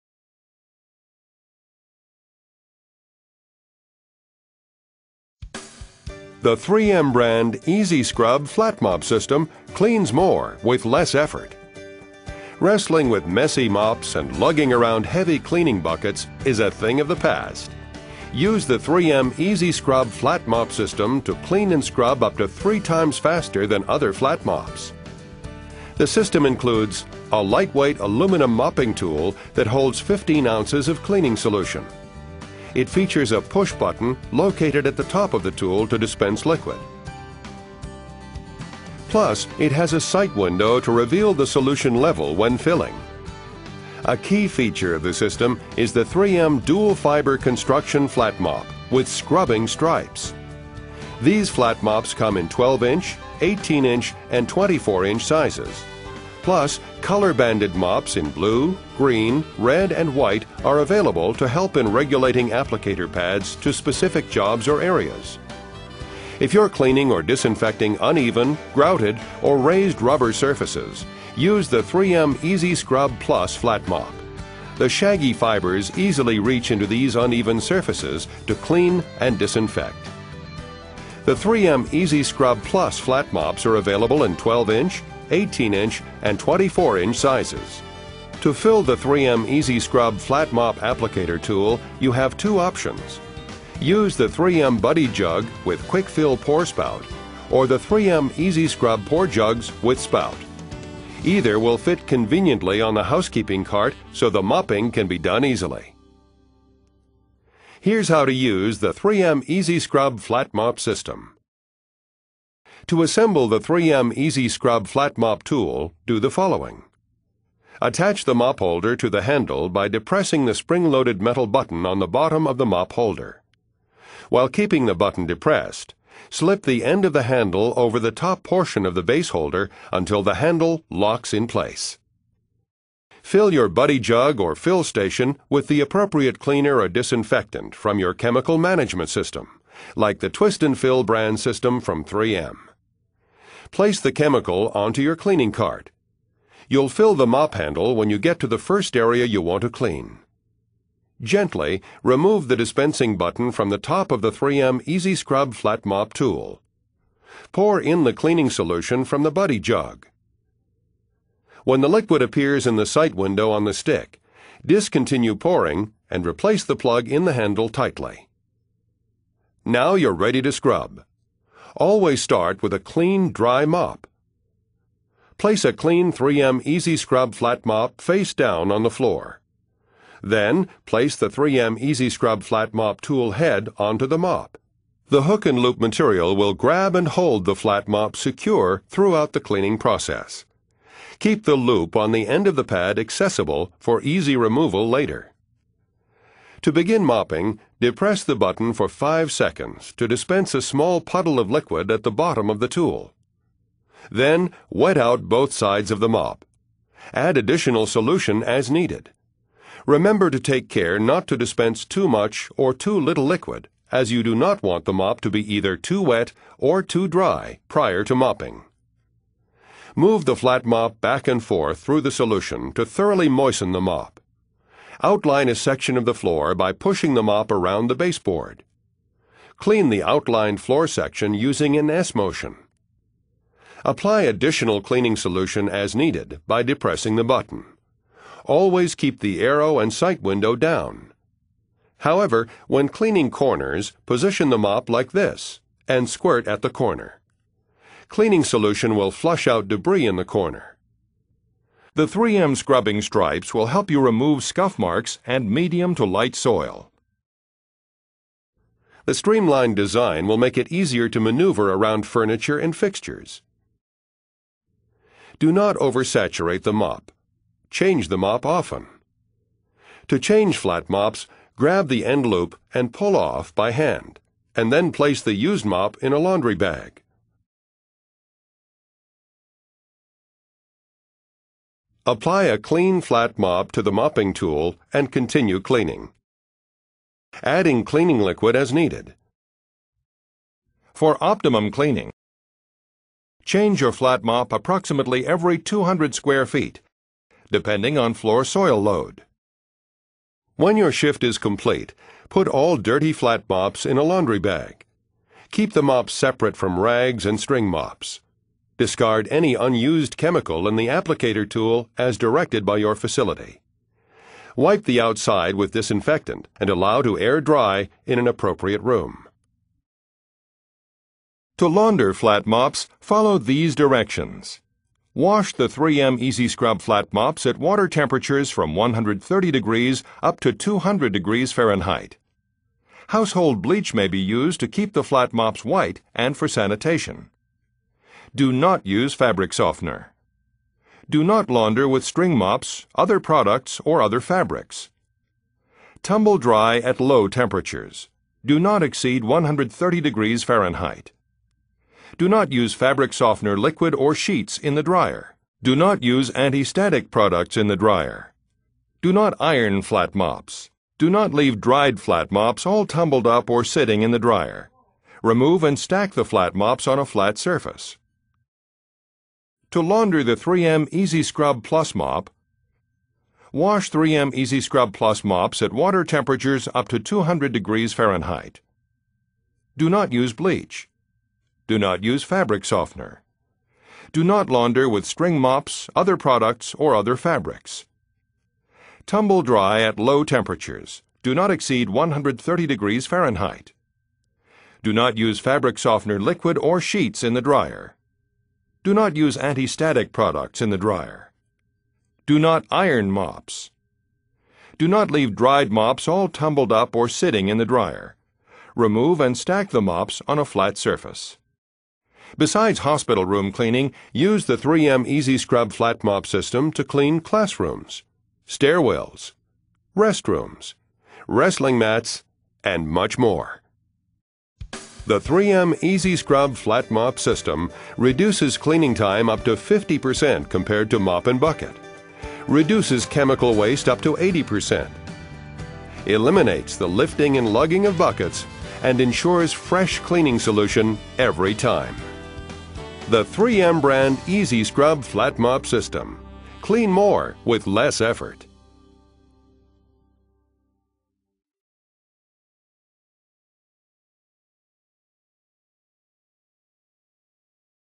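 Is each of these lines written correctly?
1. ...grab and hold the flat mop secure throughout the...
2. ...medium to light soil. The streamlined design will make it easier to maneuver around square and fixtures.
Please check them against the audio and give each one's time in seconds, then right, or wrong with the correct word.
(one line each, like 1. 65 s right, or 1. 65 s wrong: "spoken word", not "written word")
1. 186 s right
2. 255 s wrong: "furniture", not "square".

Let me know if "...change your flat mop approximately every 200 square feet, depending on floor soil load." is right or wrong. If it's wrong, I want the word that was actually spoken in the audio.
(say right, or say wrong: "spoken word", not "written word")
right.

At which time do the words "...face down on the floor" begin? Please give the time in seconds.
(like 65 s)
178 s.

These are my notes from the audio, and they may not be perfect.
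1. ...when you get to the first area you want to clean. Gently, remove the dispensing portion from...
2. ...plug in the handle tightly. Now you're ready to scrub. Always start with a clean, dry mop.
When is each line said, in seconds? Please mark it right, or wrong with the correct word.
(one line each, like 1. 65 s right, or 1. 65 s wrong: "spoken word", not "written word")
1. 147 s wrong: "button", not "portion"
2. 166 s right.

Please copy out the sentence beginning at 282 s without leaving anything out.
Apply a clean flat mop to the mopping tool and continue cleaning.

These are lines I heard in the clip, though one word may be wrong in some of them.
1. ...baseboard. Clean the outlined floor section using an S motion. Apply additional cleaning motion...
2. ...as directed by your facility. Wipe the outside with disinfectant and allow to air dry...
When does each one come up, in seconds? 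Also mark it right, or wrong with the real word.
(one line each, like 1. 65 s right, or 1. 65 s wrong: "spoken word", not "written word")
1. 227 s wrong: "solution", not "motion"
2. 311 s right.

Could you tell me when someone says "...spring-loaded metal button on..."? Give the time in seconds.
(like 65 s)
120 s.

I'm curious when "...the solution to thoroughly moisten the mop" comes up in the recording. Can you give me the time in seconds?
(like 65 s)
222 s.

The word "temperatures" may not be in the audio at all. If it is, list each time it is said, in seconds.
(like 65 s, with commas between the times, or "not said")
327 s, 347 s, 376 s, 390 s.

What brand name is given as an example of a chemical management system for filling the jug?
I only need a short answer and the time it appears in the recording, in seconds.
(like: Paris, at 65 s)
Twist and Fill, at 140 s.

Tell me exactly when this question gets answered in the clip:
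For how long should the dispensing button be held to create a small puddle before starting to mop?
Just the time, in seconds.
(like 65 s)
198 s.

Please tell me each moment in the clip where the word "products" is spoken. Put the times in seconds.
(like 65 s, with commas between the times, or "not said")
343 s, 357 s, 386 s, 400 s.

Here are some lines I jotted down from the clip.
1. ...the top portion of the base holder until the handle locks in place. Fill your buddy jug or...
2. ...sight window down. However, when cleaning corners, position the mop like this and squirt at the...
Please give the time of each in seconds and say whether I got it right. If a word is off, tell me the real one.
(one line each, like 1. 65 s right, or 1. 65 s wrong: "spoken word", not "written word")
1. 127 s right
2. 239 s right.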